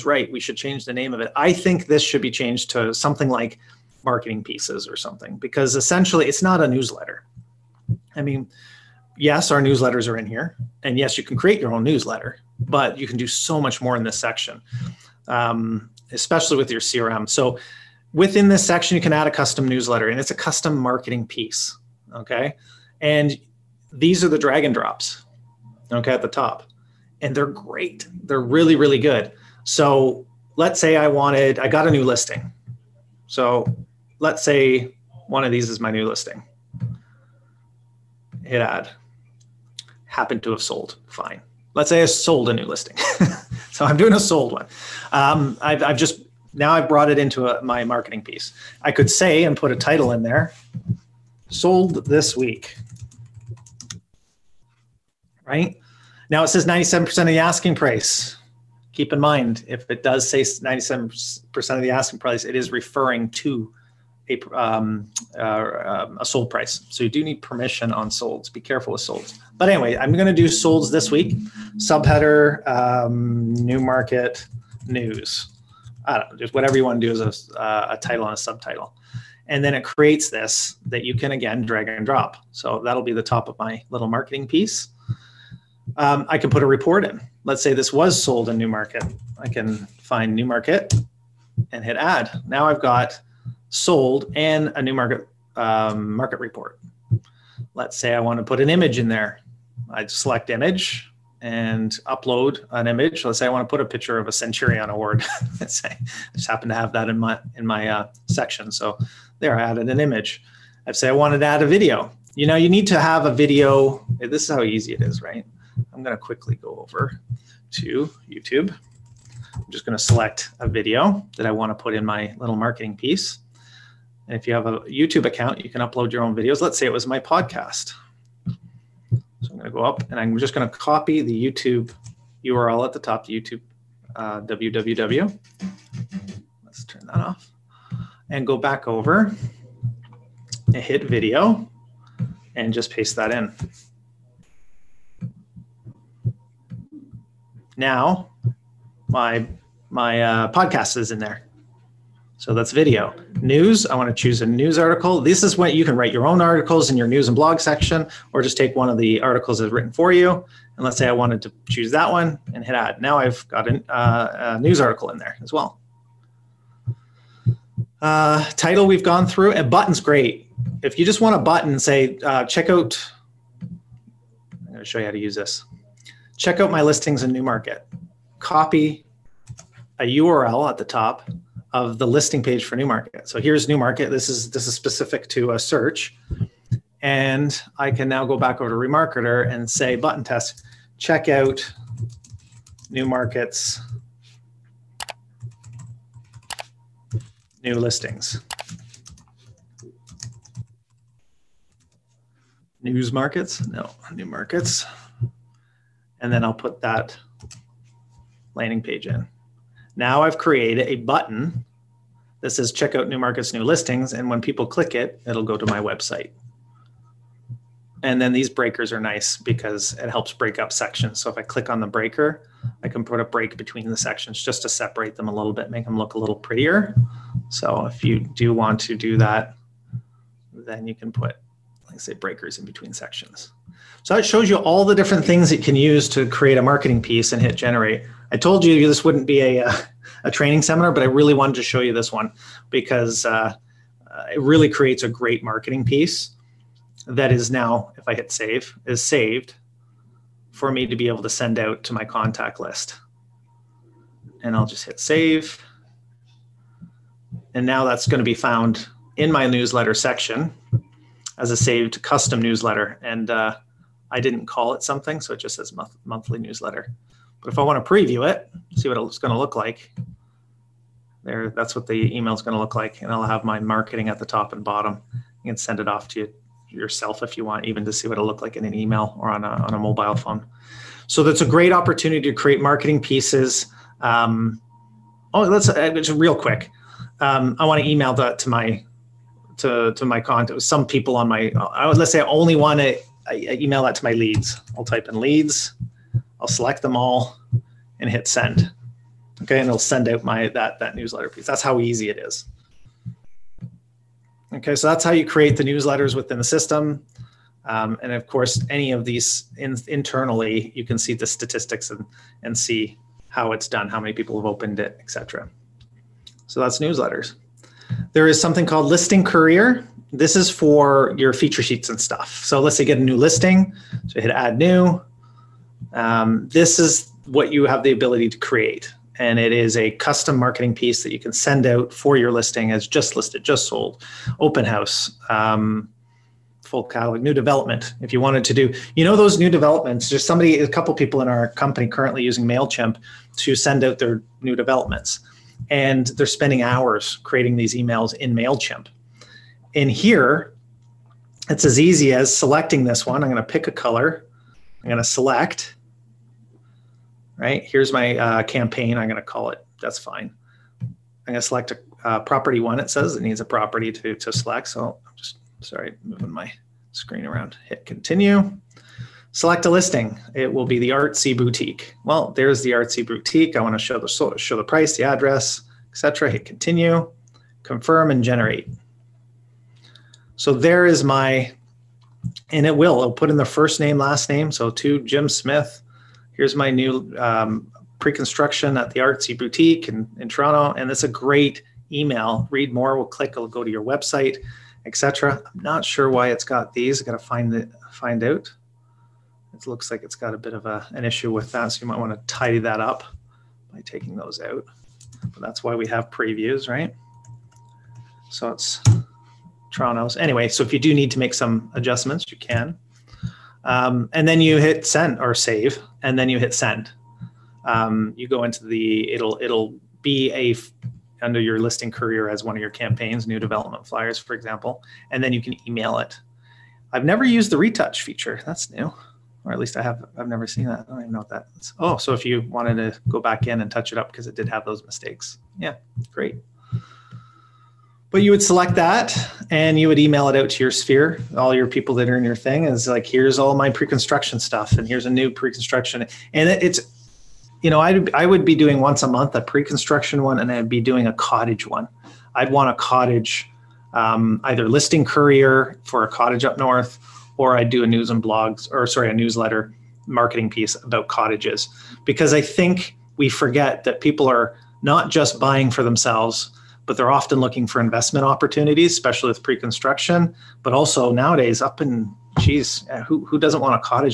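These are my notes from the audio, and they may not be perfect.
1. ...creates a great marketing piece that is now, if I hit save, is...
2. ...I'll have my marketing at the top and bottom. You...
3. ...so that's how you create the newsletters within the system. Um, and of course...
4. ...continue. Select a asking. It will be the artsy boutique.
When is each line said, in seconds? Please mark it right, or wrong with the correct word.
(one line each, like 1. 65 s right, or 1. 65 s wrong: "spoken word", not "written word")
1. 244 s right
2. 273 s right
3. 304 s right
4. 367 s wrong: "listing", not "asking".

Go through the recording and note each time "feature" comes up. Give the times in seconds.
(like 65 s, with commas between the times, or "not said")
321 s, 428 s.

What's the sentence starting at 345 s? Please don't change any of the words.
And they're spending hours creating these emails in MailChimp in here, it's as easy as selecting this one.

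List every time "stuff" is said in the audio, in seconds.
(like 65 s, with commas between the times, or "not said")
322 s, 444 s.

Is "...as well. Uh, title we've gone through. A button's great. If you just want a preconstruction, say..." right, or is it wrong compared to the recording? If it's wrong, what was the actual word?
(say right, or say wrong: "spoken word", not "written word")
wrong: "button", not "preconstruction".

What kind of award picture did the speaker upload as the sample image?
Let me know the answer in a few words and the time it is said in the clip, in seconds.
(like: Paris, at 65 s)
Centurion award, at 104 s.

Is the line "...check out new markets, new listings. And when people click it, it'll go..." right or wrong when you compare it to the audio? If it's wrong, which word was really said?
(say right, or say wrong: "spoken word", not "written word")
right.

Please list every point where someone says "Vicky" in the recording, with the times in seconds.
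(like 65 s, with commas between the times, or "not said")
not said.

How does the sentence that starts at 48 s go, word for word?
I could say and put a title in there sold this week right?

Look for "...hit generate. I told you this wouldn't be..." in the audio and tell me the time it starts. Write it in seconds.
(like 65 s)
237 s.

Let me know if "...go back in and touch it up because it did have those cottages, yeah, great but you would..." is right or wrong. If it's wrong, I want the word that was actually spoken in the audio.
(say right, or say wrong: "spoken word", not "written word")
wrong: "mistakes", not "cottages".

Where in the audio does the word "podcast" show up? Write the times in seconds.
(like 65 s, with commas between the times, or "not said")
127 s, 150 s.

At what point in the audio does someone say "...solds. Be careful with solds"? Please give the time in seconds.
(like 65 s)
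68 s.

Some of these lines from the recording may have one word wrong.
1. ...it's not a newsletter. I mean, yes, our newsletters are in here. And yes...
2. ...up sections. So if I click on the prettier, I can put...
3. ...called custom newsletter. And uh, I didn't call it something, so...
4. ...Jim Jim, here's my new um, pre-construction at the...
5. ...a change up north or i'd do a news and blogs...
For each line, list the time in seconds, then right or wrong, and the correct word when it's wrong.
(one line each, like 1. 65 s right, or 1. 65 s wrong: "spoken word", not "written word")
1. 6 s right
2. 220 s wrong: "breaker", not "prettier"
3. 261 s wrong: "saved", not "called"
4. 385 s wrong: "Smith", not "Jim"
5. 456 s wrong: "cottage", not "change".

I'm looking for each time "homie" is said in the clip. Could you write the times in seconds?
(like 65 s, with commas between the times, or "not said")
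not said.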